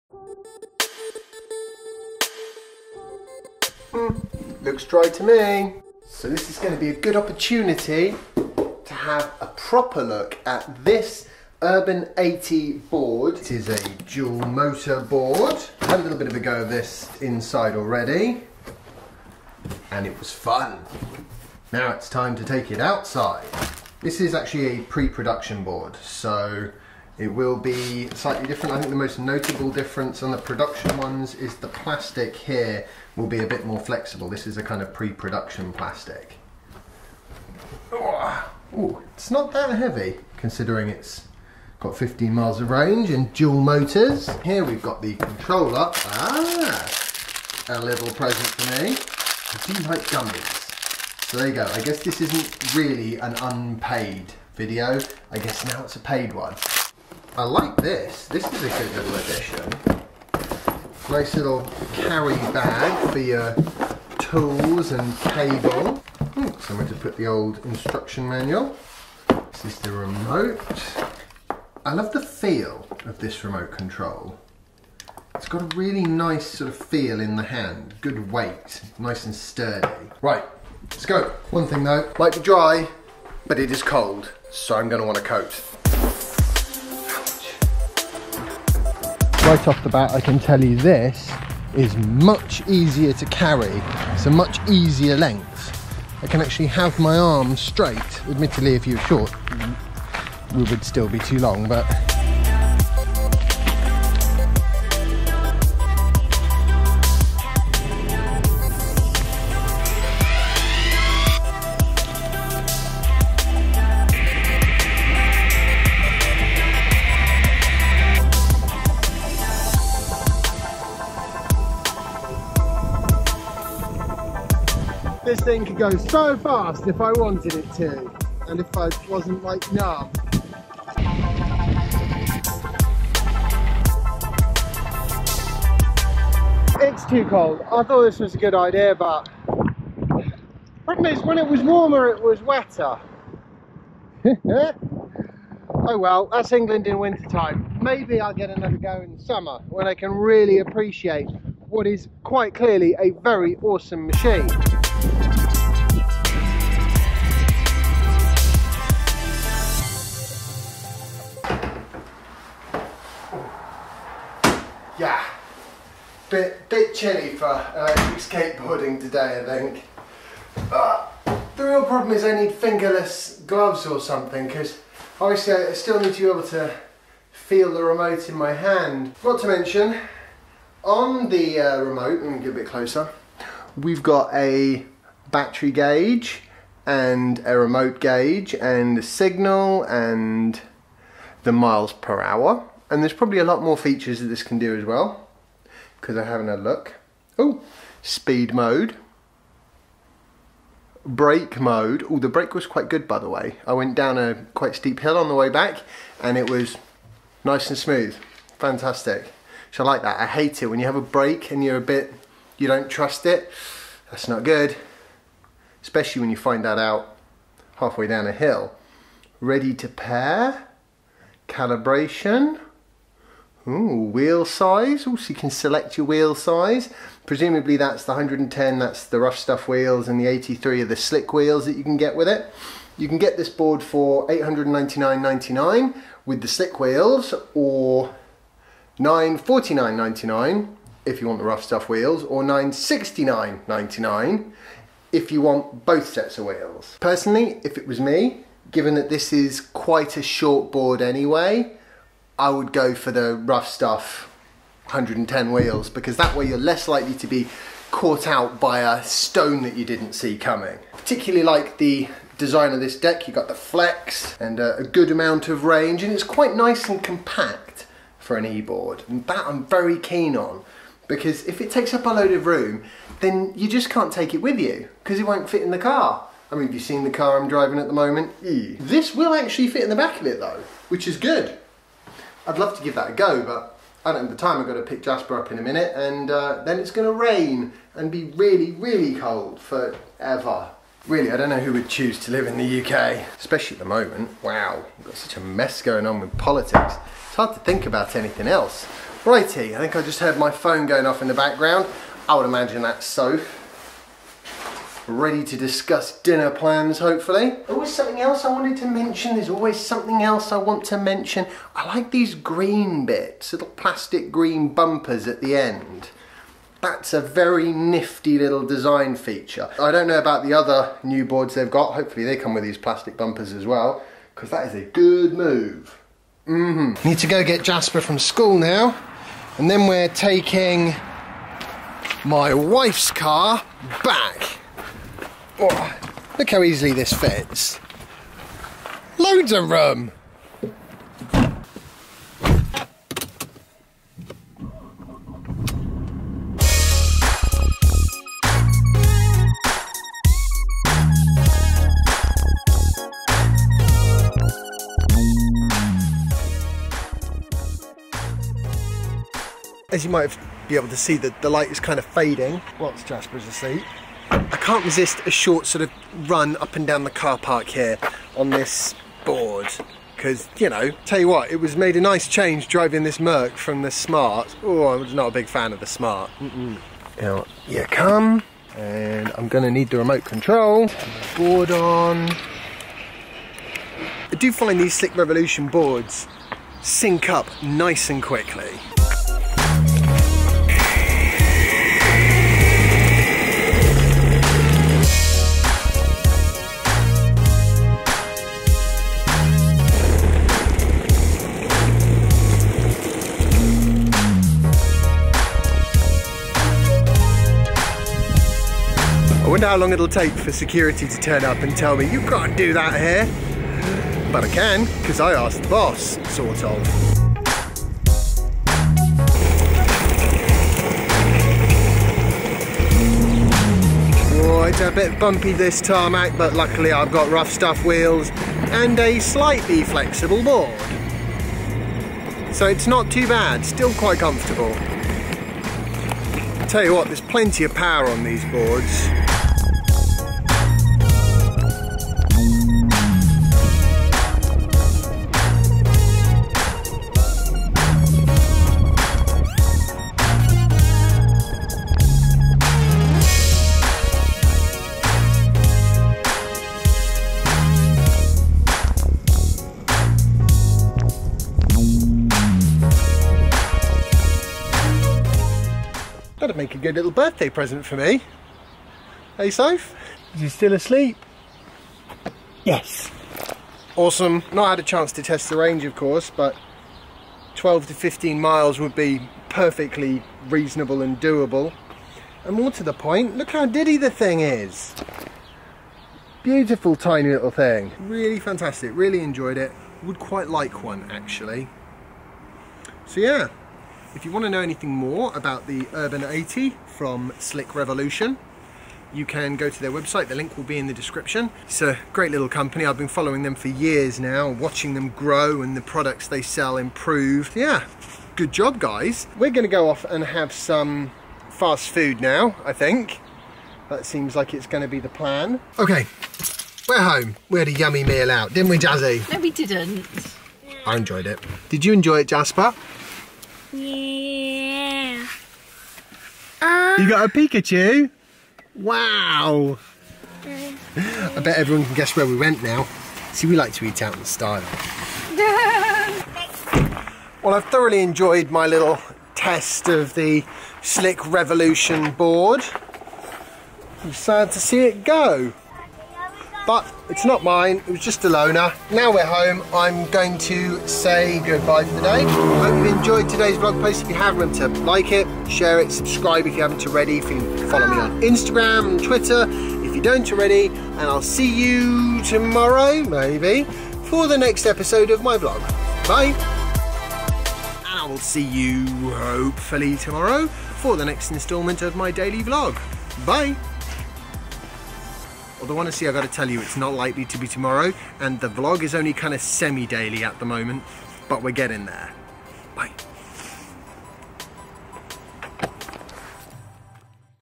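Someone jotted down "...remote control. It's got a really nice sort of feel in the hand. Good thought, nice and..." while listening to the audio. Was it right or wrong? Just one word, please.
wrong.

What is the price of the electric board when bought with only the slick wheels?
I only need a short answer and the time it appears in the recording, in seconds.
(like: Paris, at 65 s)
899.99, at 234 s.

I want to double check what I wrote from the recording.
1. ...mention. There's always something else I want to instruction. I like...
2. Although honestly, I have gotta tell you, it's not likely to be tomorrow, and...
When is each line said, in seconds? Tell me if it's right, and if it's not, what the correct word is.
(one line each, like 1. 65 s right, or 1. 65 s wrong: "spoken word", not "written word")
1. 308 s wrong: "mention", not "instruction"
2. 575 s right.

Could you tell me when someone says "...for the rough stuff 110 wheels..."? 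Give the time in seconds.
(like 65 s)
252 s.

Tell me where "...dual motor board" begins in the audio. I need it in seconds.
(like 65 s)
14 s.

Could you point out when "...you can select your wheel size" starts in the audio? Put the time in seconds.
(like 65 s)
225 s.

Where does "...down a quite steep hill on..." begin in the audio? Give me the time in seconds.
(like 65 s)
203 s.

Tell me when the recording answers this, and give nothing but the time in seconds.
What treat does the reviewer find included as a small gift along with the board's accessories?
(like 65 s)
50 s.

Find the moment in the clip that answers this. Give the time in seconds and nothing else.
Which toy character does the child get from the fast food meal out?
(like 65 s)
527 s.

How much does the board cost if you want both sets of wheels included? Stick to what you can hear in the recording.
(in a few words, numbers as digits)
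969.99.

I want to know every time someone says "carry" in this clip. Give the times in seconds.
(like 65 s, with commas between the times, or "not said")
61 s, 93 s.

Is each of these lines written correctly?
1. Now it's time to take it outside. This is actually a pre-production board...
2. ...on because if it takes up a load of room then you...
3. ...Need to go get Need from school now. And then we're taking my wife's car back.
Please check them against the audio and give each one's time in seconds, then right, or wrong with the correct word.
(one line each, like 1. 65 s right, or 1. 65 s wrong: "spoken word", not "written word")
1. 21 s right
2. 270 s right
3. 327 s wrong: "Jasper", not "Need".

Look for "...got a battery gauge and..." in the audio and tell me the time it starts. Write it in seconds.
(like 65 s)
184 s.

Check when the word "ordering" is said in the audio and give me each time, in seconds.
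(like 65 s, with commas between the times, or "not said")
not said.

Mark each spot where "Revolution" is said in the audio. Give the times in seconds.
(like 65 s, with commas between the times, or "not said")
385 s, 497 s, 541 s.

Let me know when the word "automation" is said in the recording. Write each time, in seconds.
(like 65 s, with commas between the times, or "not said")
not said.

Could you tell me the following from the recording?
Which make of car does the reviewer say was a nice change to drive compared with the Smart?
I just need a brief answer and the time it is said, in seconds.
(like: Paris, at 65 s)
Merc, at 373 s.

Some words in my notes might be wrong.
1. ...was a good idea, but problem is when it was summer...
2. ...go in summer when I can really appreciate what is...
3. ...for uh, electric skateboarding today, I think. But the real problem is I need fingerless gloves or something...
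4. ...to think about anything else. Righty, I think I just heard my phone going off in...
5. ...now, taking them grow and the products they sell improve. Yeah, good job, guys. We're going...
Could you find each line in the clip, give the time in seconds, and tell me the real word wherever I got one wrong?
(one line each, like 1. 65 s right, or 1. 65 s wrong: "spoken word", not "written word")
1. 138 s wrong: "warmer", not "summer"
2. 148 s right
3. 167 s right
4. 297 s right
5. 504 s wrong: "watching", not "taking".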